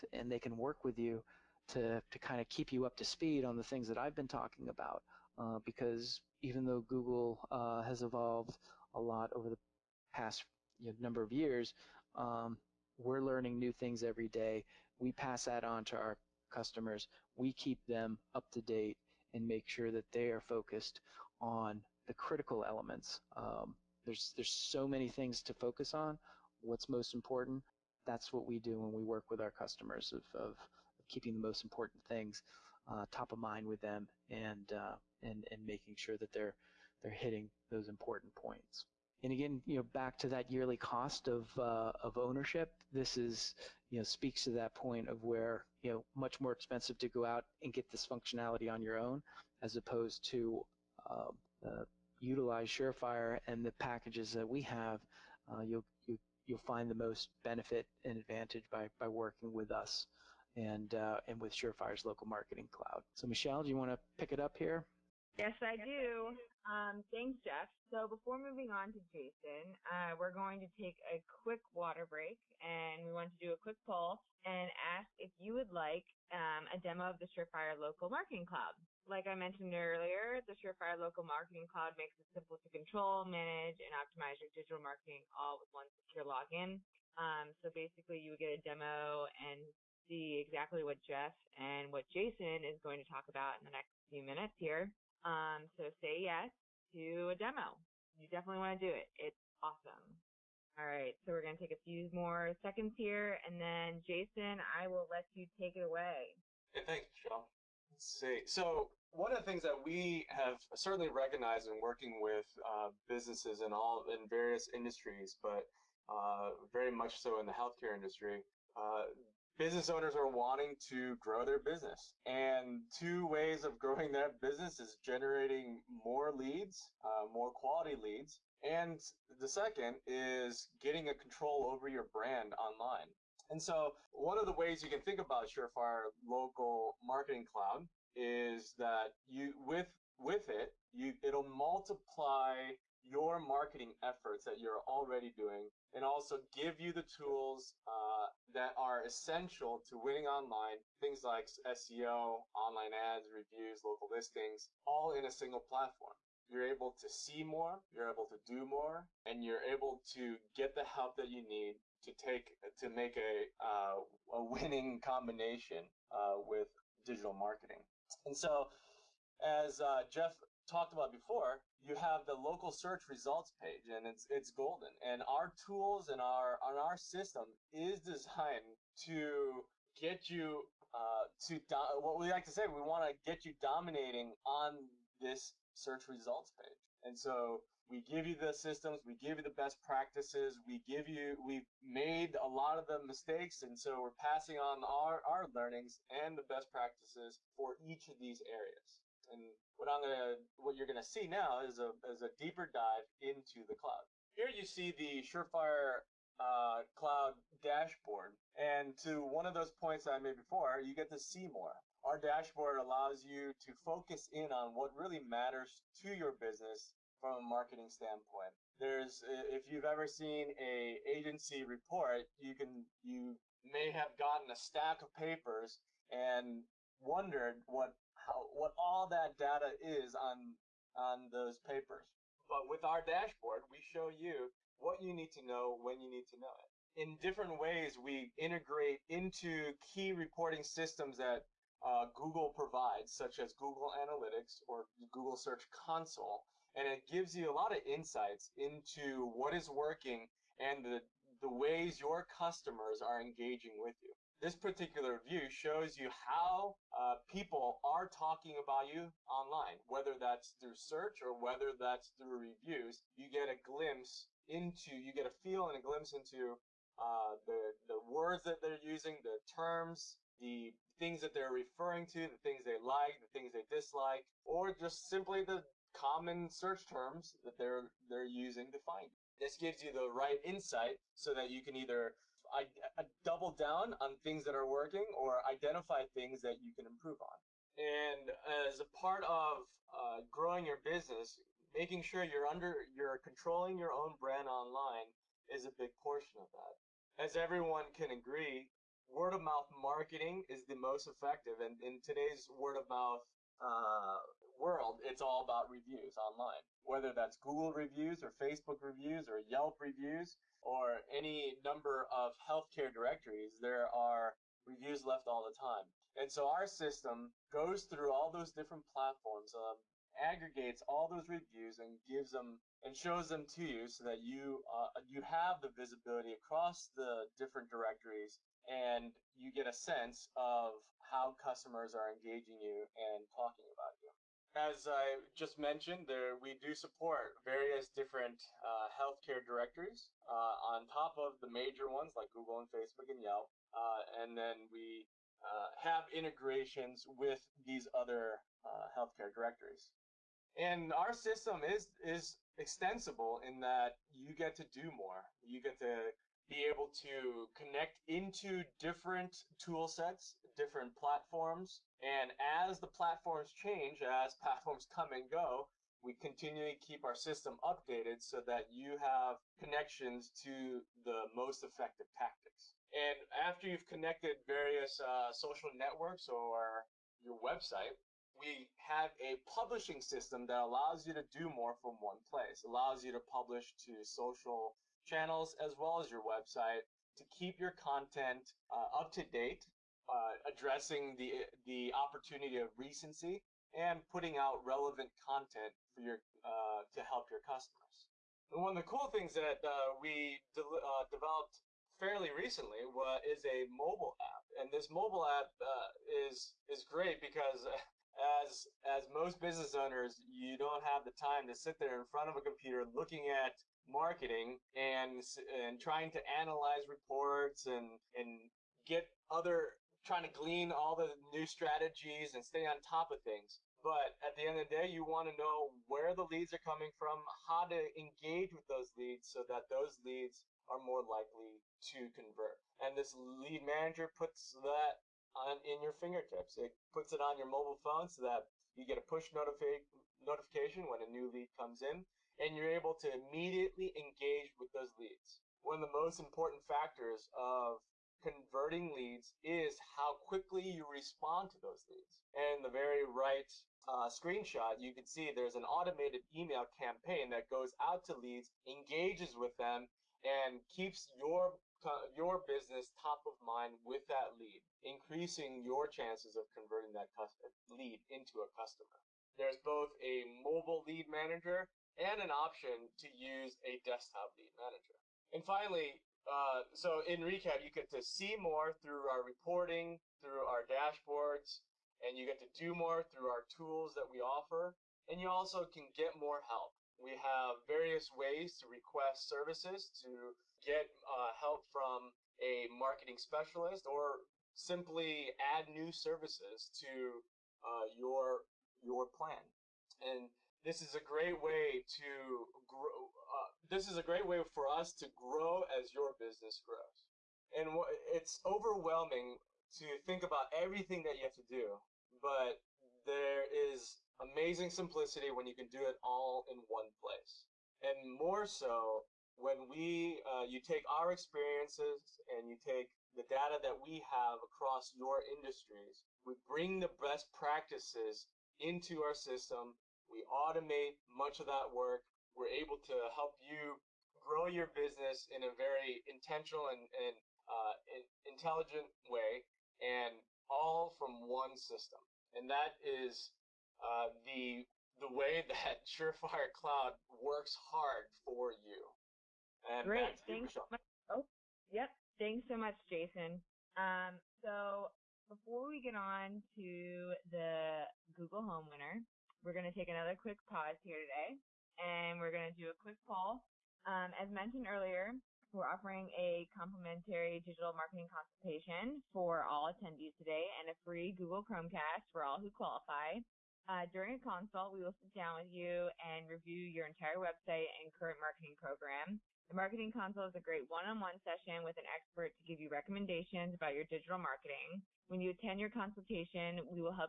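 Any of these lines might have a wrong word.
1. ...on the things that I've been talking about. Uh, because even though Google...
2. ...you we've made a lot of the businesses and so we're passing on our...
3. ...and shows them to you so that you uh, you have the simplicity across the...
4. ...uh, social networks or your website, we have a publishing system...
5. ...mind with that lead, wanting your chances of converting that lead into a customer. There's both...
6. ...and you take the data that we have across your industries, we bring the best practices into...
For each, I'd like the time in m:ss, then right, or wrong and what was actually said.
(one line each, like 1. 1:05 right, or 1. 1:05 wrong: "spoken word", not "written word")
1. 0:03 right
2. 3:11 wrong: "mistakes", not "businesses"
3. 5:22 wrong: "visibility", not "simplicity"
4. 6:14 right
5. 7:43 wrong: "increasing", not "wanting"
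6. 8:42 right.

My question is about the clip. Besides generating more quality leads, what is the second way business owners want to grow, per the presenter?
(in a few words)
control over your brand online.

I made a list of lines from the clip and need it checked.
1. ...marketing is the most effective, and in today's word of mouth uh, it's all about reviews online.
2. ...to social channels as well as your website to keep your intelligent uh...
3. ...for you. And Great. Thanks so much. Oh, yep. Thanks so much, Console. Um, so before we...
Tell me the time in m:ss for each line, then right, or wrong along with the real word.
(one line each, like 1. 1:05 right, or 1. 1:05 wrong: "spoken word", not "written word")
1. 4:59 right
2. 6:23 wrong: "content", not "intelligent"
3. 9:08 wrong: "Jason", not "Console".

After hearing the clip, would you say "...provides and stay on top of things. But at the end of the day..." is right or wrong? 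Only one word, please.
wrong.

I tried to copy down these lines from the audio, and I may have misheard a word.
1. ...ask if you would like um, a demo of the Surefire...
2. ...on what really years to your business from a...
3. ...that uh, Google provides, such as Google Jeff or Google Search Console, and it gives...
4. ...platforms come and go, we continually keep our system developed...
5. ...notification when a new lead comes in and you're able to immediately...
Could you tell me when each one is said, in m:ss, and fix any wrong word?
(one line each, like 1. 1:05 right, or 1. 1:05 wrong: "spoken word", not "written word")
1. 1:14 right
2. 3:34 wrong: "matters", not "years"
3. 4:01 wrong: "Analytics", not "Jeff"
4. 6:04 wrong: "updated", not "developed"
5. 7:20 right.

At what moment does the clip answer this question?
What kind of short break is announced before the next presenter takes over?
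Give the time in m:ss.
1:11.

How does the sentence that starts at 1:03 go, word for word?
So Michelle, do you want to pick it up here?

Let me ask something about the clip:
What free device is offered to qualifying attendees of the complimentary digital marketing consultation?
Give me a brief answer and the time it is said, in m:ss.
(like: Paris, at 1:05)
Google Chromecast, at 9:31.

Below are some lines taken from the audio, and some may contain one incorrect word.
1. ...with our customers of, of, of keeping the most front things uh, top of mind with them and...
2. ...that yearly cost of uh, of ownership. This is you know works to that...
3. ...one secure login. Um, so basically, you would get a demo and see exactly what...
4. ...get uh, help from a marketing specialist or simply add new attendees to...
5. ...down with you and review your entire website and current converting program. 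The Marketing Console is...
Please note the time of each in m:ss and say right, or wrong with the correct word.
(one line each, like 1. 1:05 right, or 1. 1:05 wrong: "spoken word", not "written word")
1. 0:29 wrong: "important", not "front"
2. 0:40 wrong: "speaks", not "works"
3. 1:25 right
4. 8:10 wrong: "services", not "attendees"
5. 9:35 wrong: "marketing", not "converting".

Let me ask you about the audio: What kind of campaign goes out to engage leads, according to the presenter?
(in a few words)
automated email campaign.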